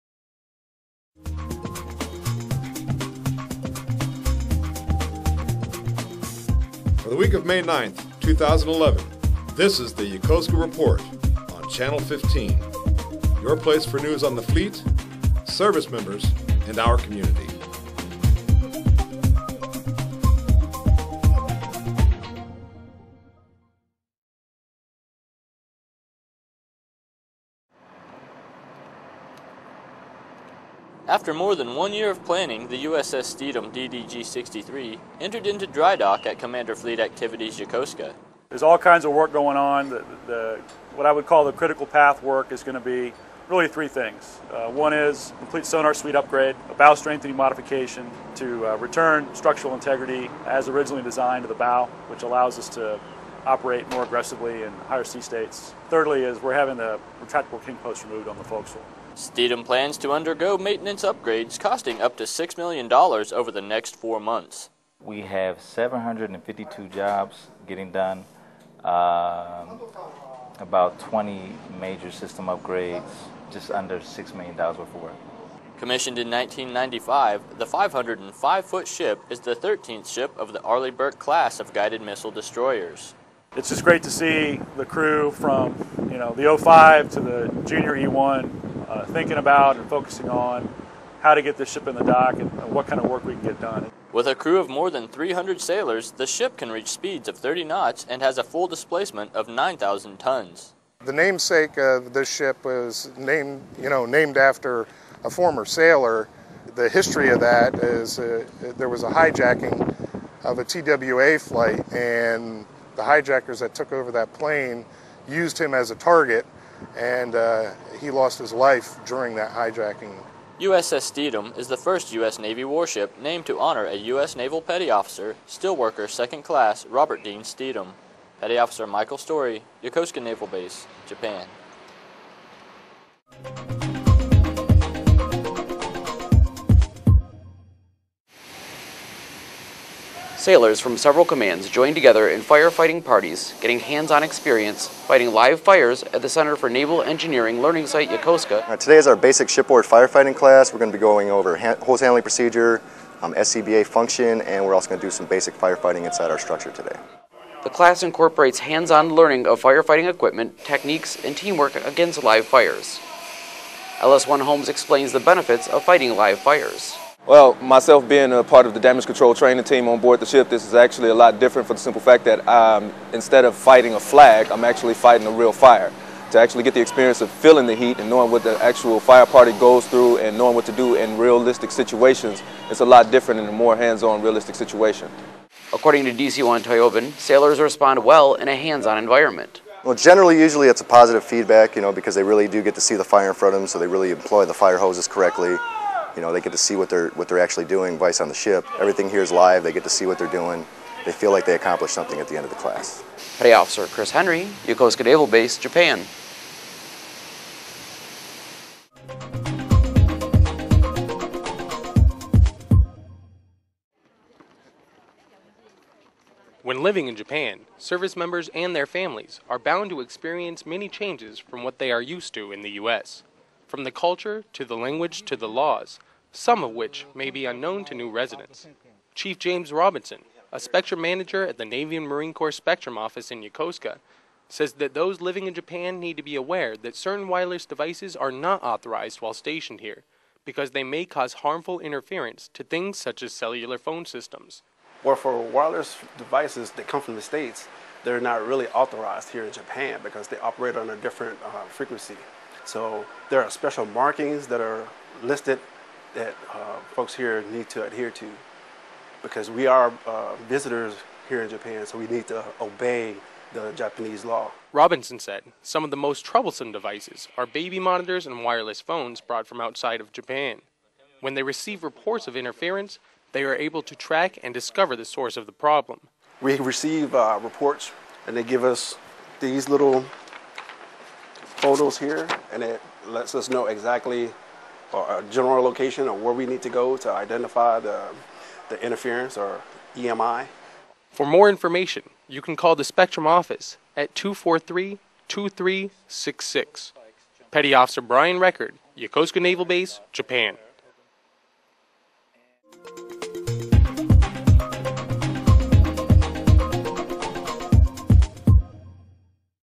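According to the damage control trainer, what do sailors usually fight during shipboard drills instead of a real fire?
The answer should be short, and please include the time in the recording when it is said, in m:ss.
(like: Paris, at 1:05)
A flag, at 2:53.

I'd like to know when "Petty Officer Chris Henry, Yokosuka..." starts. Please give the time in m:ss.
3:23.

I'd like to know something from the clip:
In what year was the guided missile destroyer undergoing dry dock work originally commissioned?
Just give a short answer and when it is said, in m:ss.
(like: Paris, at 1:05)
1995, at 1:16.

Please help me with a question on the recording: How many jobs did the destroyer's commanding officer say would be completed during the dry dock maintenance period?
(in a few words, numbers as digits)
752.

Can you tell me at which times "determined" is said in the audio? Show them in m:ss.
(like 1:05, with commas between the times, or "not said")
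not said.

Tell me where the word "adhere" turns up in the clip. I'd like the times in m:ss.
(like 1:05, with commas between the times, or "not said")
4:17.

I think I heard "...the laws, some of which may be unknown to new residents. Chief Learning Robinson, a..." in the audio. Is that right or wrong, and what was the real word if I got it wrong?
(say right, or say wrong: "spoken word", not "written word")
wrong: "James", not "Learning".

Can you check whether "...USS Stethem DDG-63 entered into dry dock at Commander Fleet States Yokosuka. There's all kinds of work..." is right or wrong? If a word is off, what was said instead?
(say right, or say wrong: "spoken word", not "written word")
wrong: "Activities", not "States".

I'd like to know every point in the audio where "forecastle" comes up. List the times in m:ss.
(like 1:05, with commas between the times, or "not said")
0:58.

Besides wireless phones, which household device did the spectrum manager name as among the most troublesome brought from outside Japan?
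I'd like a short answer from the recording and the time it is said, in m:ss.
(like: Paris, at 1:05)
Baby monitors, at 4:27.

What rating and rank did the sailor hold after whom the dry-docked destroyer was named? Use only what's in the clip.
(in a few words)
Steelworker Second Class.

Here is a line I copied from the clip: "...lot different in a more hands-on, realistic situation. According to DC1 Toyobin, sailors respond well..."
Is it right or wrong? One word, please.
right.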